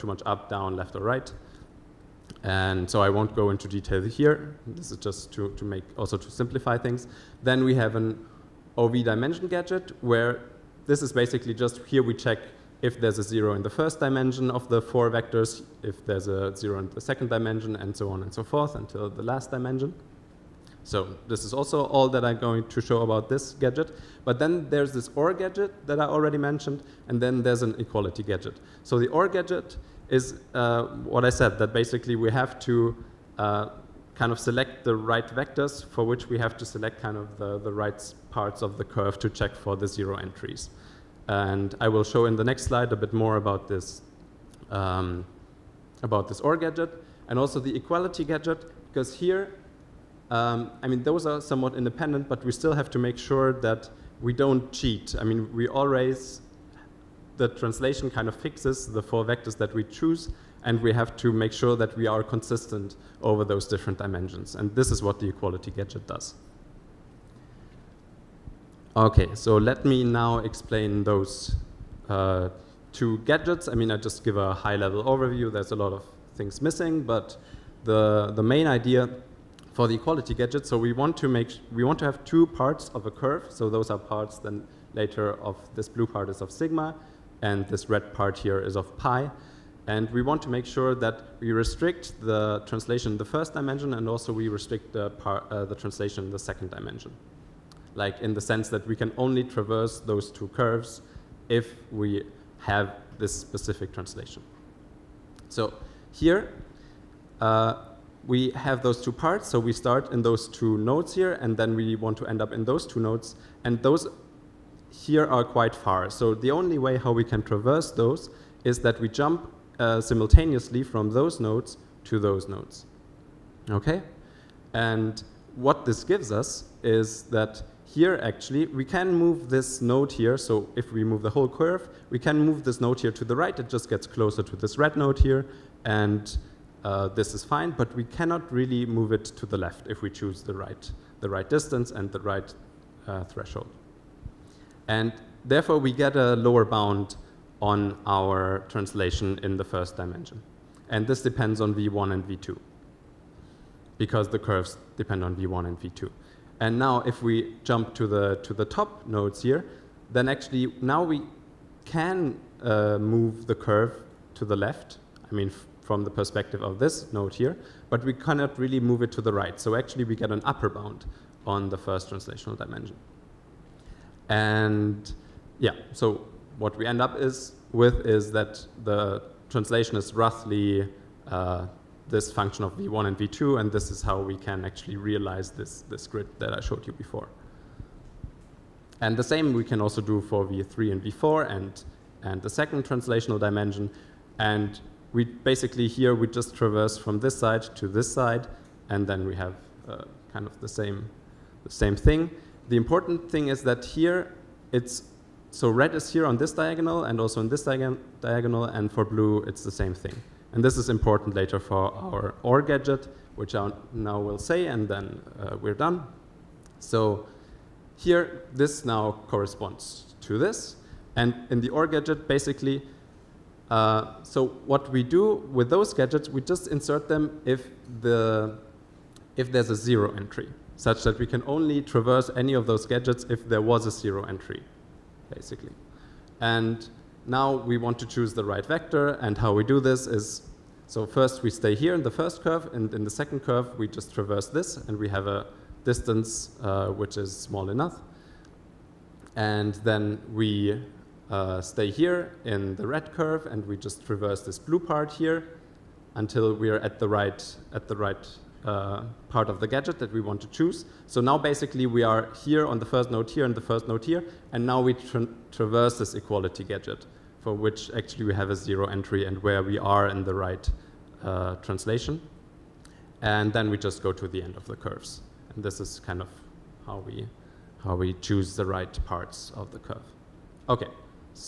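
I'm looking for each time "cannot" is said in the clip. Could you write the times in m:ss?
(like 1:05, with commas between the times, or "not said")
2:18, 2:48.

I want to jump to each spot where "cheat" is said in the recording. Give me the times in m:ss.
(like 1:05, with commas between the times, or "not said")
0:54.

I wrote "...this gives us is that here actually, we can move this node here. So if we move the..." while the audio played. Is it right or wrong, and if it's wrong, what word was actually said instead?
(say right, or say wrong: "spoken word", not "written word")
right.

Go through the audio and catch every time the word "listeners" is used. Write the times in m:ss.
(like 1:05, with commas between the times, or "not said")
not said.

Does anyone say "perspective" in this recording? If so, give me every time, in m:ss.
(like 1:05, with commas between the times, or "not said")
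2:46.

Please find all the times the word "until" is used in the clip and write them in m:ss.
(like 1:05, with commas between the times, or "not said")
0:18, 4:16.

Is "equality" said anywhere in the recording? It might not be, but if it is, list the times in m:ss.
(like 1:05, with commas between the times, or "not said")
0:27, 0:47, 1:05, 1:19, 4:26.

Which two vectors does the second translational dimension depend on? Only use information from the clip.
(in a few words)
v3 and v4.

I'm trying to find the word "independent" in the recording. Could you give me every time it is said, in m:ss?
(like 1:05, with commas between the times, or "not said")
0:51.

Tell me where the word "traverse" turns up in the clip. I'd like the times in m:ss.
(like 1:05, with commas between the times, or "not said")
1:39, 1:57, 3:16, 3:51, 4:04, 4:14, 4:25.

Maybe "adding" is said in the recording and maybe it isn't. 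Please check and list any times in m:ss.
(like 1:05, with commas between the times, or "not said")
not said.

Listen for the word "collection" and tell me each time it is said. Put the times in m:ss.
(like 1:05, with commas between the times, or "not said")
not said.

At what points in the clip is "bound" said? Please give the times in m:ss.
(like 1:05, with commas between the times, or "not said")
2:26, 2:50.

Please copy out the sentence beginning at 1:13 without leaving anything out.
I mean, I just give a high-level overview.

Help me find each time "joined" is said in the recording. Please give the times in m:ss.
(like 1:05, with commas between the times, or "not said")
not said.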